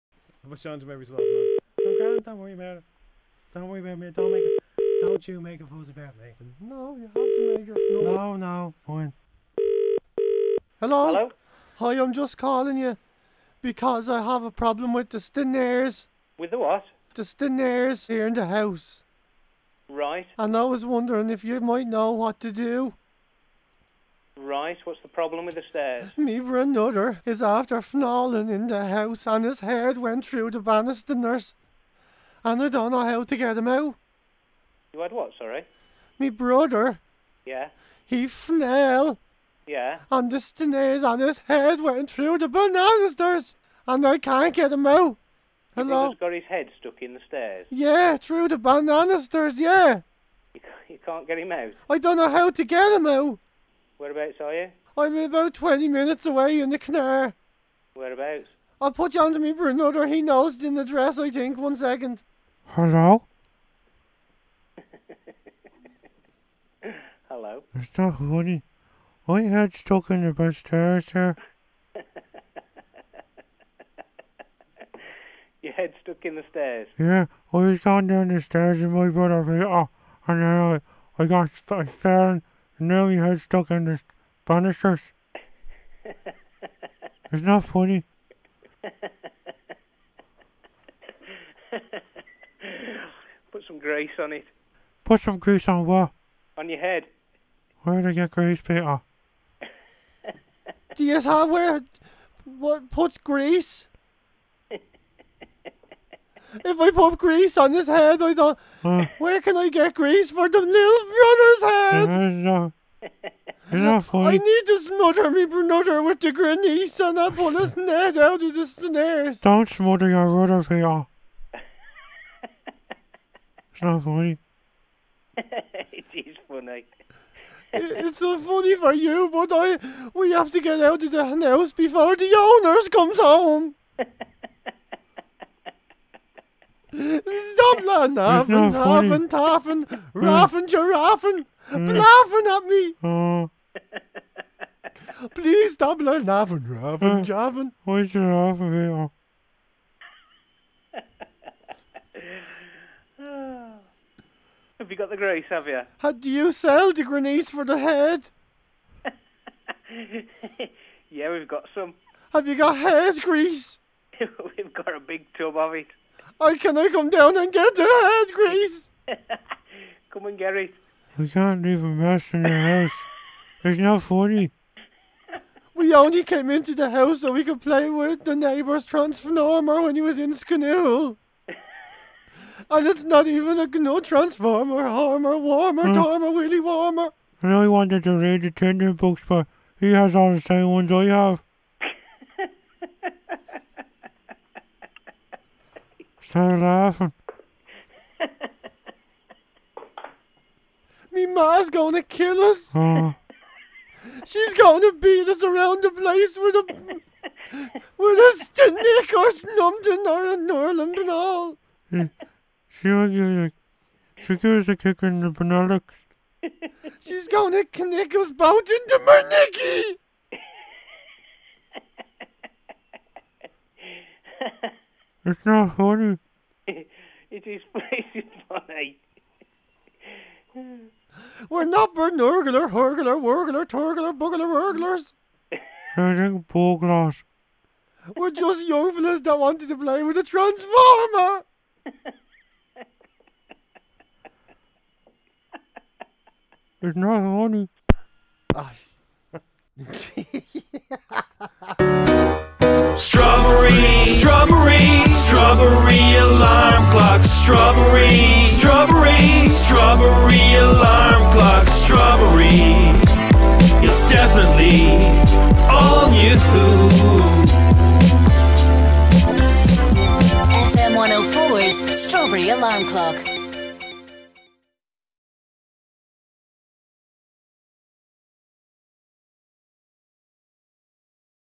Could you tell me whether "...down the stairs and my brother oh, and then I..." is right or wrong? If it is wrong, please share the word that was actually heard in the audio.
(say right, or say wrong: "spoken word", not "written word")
right.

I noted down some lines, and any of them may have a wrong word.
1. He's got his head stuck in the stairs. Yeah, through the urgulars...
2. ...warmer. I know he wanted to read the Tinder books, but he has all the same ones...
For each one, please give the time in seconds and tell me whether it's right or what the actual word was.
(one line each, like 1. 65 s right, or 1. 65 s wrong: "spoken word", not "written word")
1. 46 s wrong: "banisters", not "urgulars"
2. 186 s right.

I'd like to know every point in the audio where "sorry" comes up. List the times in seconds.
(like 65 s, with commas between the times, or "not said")
35 s.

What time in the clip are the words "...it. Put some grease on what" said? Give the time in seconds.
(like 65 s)
94 s.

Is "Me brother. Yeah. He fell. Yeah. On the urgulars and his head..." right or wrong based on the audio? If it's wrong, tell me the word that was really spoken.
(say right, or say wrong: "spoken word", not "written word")
wrong: "stairs", not "urgulars".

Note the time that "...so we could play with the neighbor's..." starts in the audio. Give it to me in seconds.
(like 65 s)
177 s.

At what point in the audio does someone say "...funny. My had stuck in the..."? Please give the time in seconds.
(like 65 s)
68 s.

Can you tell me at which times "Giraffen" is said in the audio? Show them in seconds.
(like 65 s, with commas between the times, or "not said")
140 s, 148 s.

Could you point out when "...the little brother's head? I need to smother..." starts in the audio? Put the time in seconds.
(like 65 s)
110 s.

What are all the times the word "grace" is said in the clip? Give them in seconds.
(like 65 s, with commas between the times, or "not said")
155 s, 168 s.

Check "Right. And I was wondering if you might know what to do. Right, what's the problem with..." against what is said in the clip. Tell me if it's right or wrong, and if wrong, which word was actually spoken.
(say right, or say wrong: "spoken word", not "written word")
right.